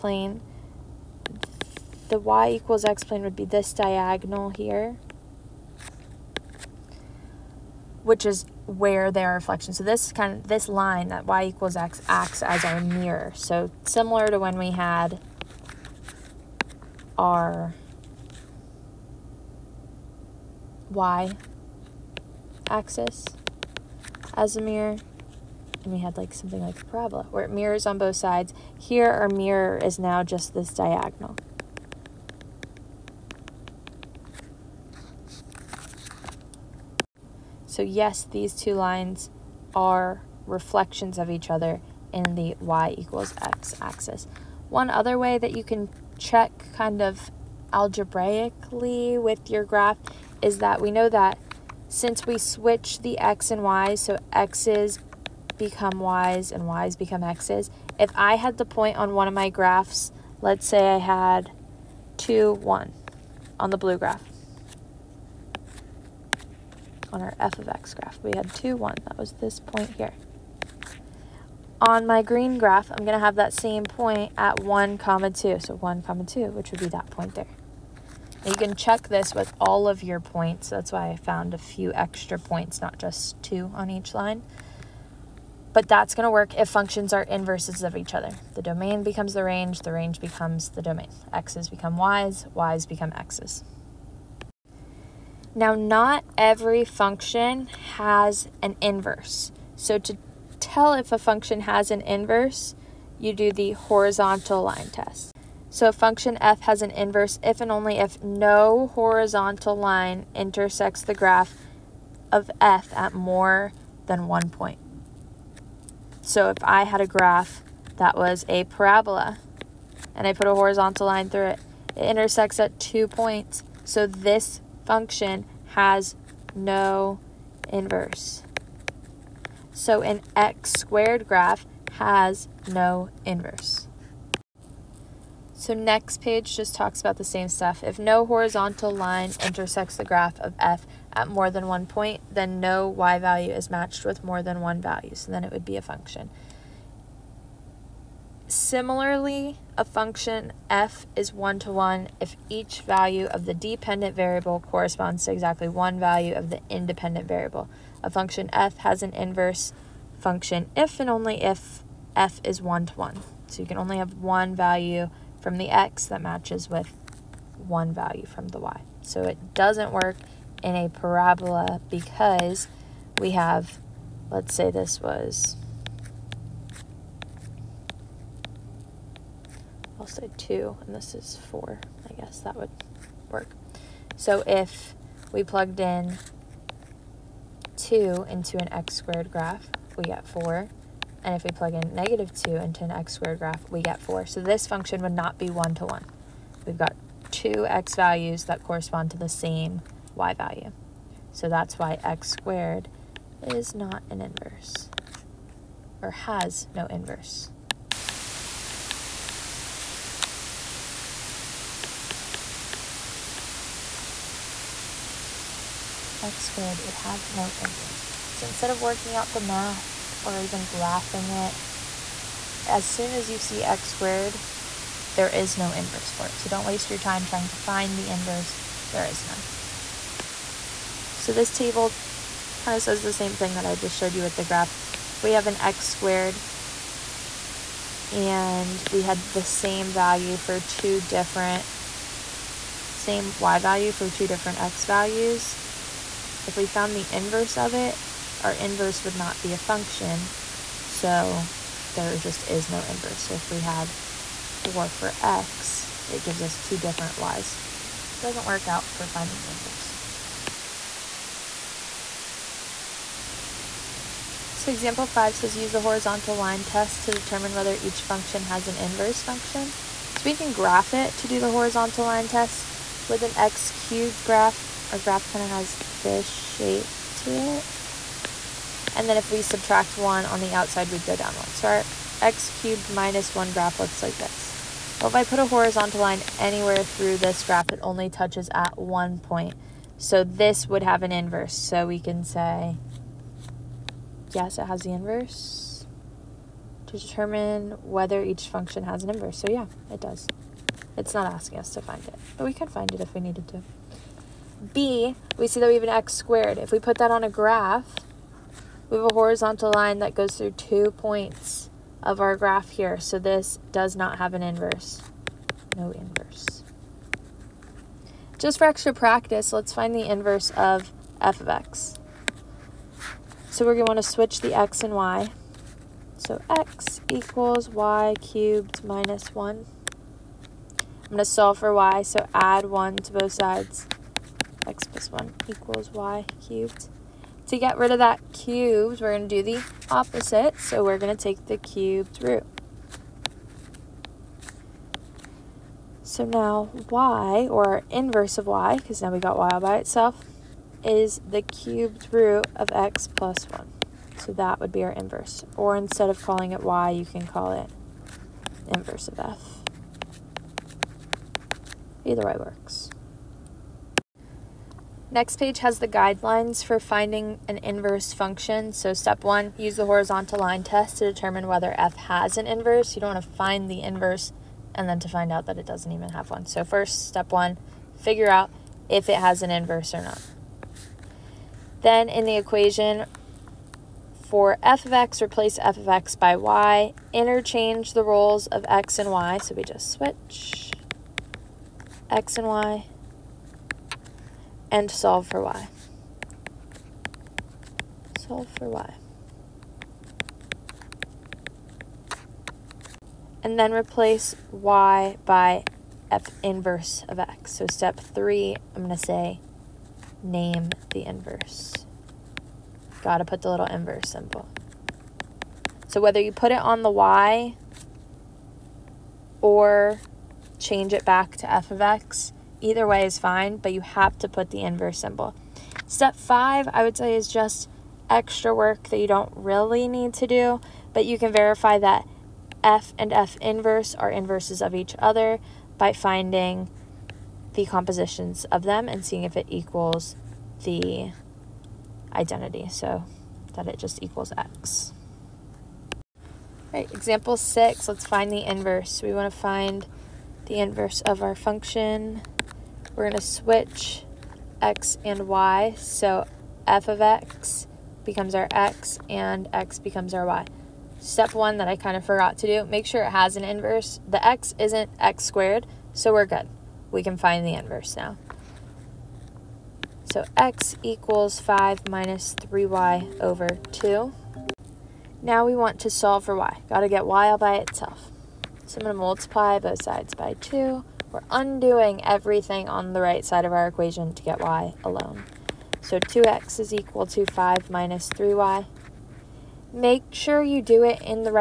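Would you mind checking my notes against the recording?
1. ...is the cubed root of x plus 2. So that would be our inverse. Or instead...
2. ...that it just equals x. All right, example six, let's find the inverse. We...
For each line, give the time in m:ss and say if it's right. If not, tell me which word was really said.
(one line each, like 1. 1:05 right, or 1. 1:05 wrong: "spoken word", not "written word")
1. 5:50 wrong: "1", not "2"
2. 7:23 right.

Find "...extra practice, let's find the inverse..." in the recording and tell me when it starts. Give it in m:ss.
5:18.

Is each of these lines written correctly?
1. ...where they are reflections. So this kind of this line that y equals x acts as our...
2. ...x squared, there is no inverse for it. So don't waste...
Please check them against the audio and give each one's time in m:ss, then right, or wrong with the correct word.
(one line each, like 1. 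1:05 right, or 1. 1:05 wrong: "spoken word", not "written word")
1. 0:08 right
2. 3:43 right.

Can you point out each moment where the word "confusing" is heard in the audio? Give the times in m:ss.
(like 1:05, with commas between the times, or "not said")
not said.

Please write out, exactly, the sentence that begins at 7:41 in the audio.
Step one that I kind of forgot to do, make sure it has an inverse.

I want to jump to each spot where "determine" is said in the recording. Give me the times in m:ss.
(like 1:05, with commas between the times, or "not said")
4:27, 4:56, 6:11.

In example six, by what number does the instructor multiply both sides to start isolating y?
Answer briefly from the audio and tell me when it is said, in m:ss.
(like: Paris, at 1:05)
2, at 7:59.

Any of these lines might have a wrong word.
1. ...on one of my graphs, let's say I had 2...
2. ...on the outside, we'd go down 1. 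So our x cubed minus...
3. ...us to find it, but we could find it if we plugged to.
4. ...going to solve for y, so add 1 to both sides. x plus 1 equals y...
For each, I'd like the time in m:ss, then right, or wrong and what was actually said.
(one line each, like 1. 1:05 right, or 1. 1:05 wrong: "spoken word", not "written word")
1. 0:58 right
2. 4:40 right
3. 5:01 wrong: "needed", not "plugged"
4. 5:31 right.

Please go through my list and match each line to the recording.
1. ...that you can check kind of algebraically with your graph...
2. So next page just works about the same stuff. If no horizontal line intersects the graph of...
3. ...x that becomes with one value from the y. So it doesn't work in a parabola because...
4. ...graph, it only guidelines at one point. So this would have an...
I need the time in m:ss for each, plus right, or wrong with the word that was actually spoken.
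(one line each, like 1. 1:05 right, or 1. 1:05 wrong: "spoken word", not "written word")
1. 0:45 right
2. 2:15 wrong: "talks", not "works"
3. 2:45 wrong: "matches", not "becomes"
4. 4:47 wrong: "touches", not "guidelines".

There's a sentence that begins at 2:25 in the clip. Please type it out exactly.
So then it would be a function.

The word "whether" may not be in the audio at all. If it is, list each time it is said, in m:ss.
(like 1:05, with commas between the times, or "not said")
4:27, 4:57, 6:11, 6:56.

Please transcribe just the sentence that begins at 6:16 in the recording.
So first, step one, figure out if it has an inverse or not.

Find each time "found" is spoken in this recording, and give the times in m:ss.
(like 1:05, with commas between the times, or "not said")
1:21, 4:06.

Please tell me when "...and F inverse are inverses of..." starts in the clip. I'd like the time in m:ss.
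7:12.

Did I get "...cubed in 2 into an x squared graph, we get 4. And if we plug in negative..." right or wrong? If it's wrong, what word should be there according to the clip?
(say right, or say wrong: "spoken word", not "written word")
wrong: "plugged", not "cubed".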